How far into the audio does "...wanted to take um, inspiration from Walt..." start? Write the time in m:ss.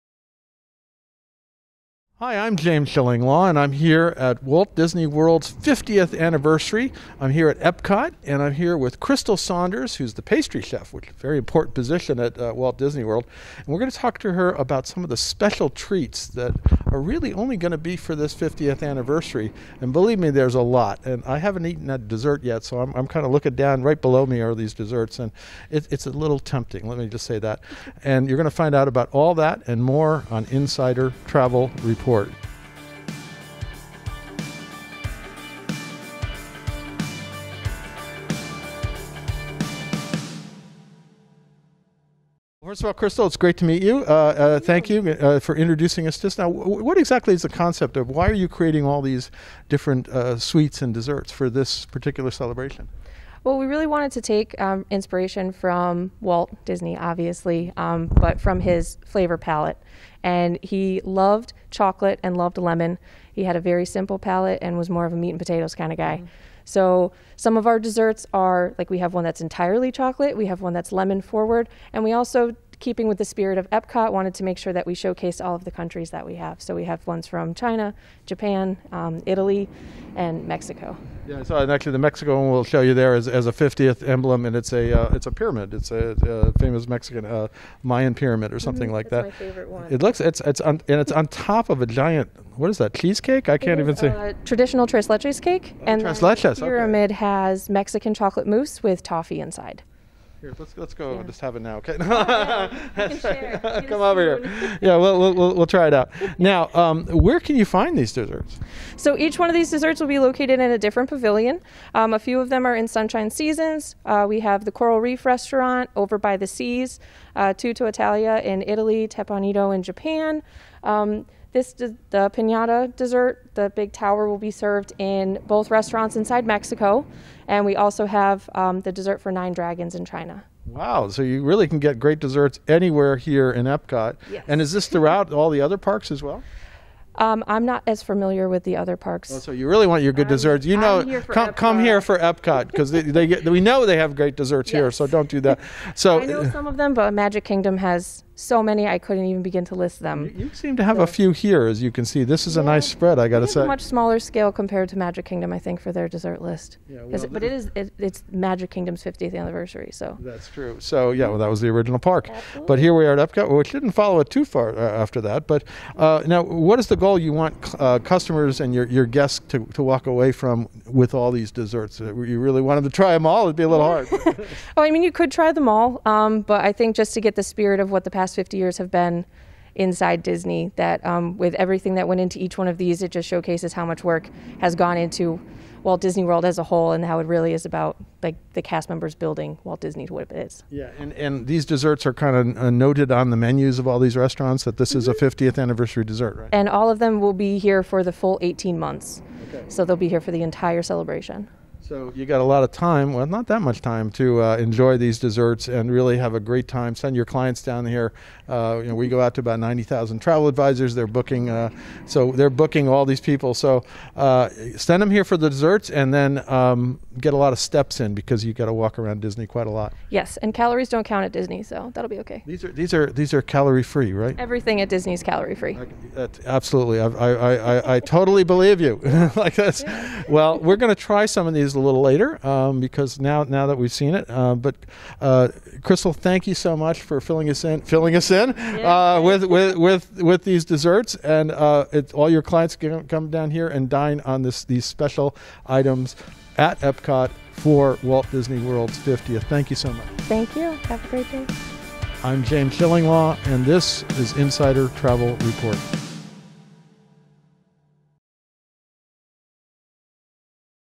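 0:53.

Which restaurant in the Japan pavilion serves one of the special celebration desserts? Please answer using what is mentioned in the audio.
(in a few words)
Teppan Edo.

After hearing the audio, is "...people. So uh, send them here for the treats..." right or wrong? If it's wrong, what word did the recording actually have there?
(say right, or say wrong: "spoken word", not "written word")
wrong: "desserts", not "treats".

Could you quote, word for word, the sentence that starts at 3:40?
Yes, and calories don't count at Disney, so that'll be okay.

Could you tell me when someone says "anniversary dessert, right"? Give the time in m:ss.
3:15.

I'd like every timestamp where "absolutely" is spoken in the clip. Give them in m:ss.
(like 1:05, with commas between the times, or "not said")
2:42, 3:46.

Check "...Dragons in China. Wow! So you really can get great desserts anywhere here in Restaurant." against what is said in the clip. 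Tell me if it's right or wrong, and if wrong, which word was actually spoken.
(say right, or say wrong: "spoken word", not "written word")
wrong: "Epcot", not "Restaurant".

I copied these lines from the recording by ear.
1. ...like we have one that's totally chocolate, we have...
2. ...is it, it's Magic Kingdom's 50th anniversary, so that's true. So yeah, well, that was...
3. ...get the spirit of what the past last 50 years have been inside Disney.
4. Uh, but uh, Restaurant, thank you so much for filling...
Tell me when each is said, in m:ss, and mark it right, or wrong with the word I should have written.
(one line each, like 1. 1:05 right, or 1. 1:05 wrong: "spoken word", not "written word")
1. 1:08 wrong: "entirely", not "totally"
2. 2:37 right
3. 2:57 right
4. 3:54 wrong: "Crystal", not "Restaurant".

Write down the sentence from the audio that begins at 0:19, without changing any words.
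And believe me, there's a lot.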